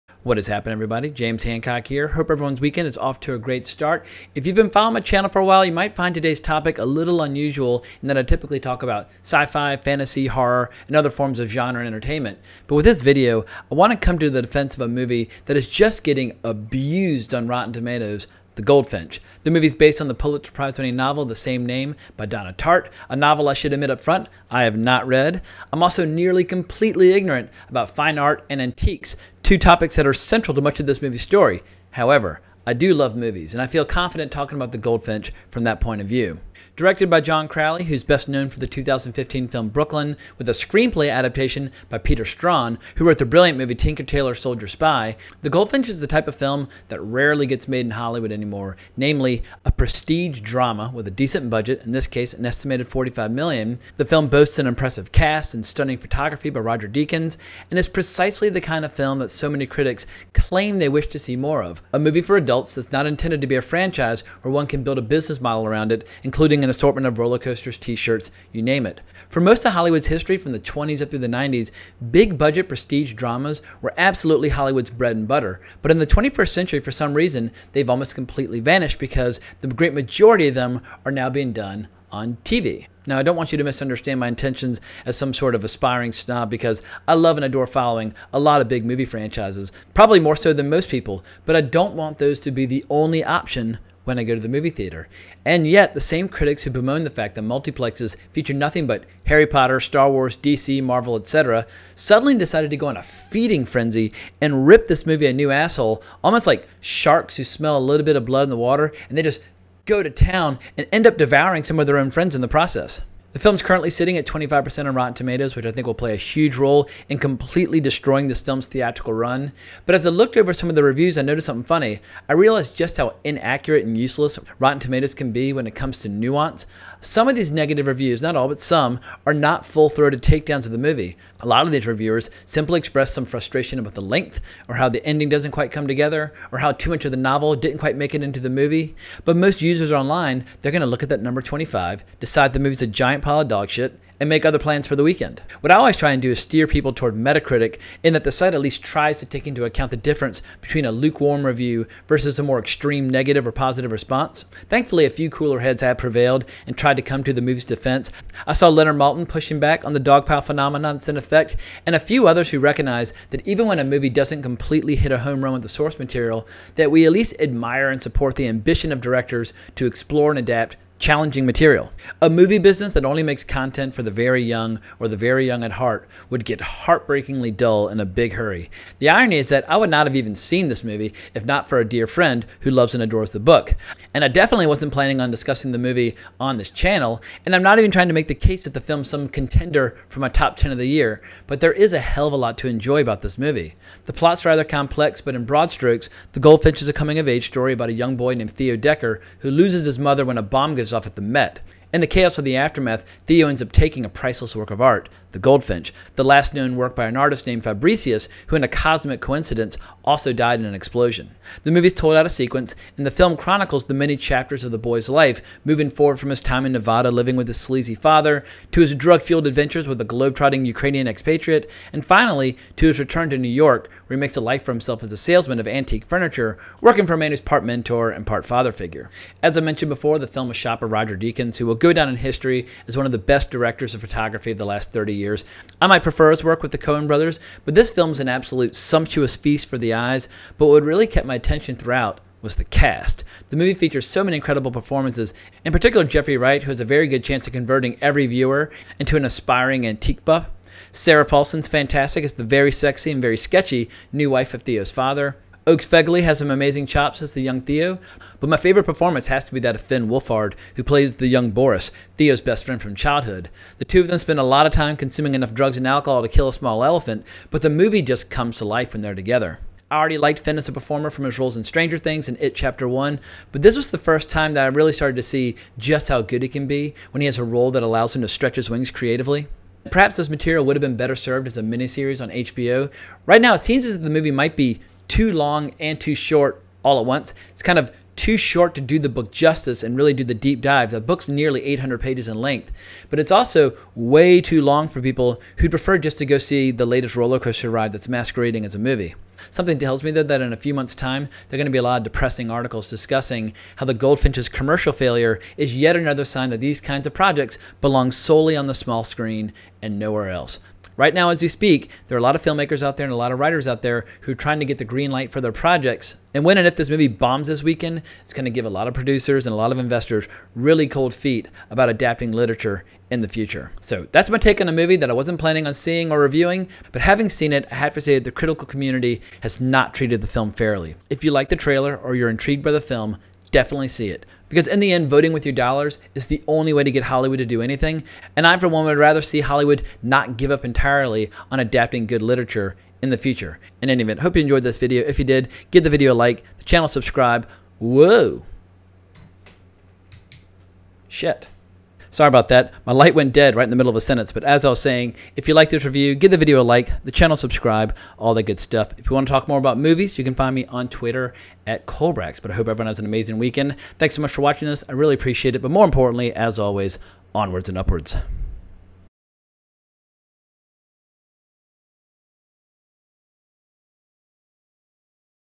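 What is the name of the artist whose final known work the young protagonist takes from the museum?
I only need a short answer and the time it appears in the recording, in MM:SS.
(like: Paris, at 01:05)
Fabricius, at 03:27.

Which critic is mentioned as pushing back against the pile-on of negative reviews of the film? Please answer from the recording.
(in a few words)
Leonard Maltin.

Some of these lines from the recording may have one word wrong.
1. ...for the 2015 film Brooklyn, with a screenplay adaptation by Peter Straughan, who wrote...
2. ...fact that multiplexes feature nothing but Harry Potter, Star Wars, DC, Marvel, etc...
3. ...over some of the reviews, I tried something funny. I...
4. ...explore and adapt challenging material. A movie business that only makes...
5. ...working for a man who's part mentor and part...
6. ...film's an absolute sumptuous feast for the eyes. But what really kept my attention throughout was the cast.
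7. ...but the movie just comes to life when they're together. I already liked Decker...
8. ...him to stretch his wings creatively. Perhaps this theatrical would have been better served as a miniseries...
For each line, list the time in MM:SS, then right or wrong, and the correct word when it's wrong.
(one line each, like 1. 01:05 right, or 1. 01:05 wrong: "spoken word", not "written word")
1. 00:38 right
2. 01:37 right
3. 02:00 wrong: "noticed", not "tried"
4. 02:49 right
5. 03:46 right
6. 03:57 right
7. 04:27 wrong: "Finn", not "Decker"
8. 04:38 wrong: "material", not "theatrical".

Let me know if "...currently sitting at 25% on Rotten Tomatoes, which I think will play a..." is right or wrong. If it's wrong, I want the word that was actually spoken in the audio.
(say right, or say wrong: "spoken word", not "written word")
right.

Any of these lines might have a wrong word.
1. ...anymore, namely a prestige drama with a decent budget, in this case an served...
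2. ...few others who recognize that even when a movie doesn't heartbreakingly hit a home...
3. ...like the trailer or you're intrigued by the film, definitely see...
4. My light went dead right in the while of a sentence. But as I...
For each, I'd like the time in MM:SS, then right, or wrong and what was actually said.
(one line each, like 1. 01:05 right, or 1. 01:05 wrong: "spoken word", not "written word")
1. 00:48 wrong: "estimated", not "served"
2. 02:41 wrong: "completely", not "heartbreakingly"
3. 05:31 right
4. 05:52 wrong: "middle", not "while".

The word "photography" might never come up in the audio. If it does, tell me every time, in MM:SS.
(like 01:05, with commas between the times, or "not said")
00:55, 03:54.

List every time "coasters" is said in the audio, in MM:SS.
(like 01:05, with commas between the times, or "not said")
01:07, 04:57.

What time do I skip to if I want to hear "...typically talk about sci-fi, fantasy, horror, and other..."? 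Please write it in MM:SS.
00:08.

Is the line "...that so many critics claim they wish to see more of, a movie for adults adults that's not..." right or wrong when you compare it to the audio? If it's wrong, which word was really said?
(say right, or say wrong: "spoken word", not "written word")
right.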